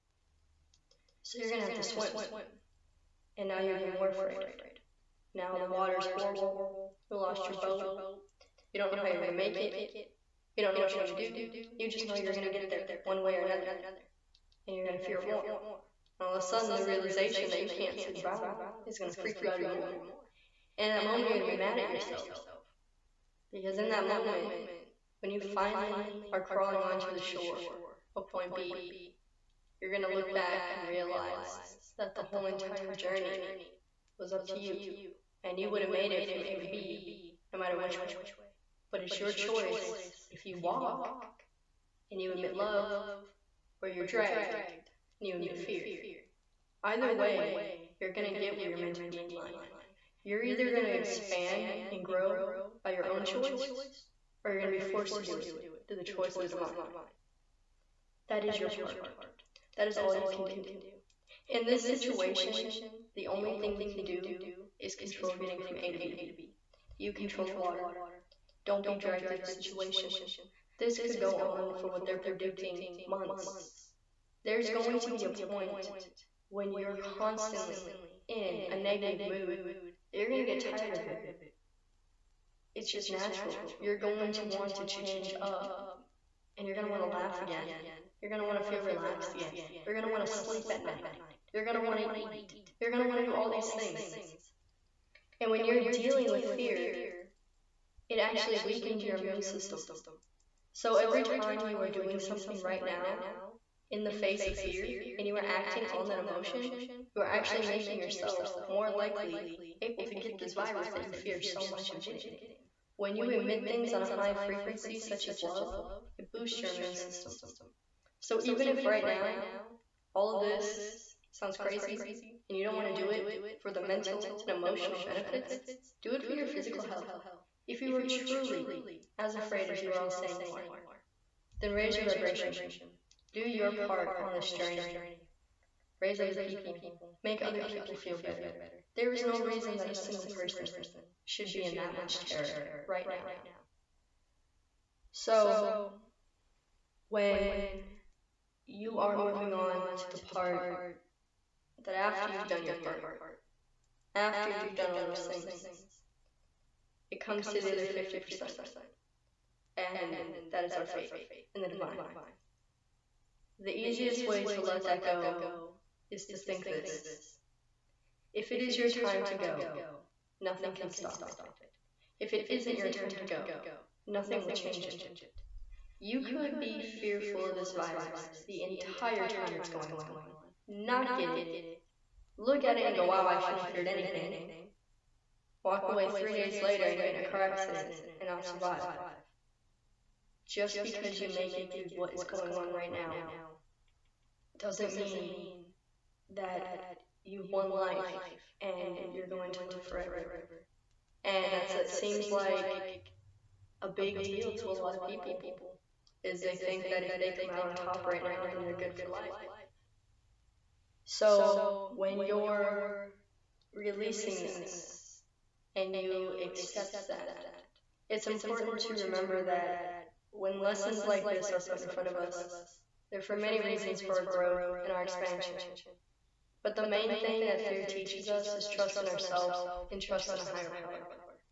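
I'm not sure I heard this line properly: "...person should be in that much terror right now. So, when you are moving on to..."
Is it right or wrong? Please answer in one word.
right.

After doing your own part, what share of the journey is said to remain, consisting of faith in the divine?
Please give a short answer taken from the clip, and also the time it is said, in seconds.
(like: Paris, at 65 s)
50%, at 157 s.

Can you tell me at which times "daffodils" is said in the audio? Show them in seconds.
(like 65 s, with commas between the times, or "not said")
not said.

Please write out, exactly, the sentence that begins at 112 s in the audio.
When you emit things on a high frequency, such as love, it boosts your immune system.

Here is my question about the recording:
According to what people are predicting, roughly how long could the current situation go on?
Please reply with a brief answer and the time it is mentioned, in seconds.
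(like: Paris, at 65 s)
months, at 73 s.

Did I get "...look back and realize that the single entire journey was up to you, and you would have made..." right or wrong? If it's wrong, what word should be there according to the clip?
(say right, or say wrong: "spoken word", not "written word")
wrong: "whole", not "single".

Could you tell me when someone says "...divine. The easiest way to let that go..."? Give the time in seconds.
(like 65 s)
161 s.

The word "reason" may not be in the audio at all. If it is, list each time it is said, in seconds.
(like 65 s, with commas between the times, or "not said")
139 s, 223 s.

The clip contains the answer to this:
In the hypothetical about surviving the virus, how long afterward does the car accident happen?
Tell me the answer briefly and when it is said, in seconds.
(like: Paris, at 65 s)
3 days later, at 186 s.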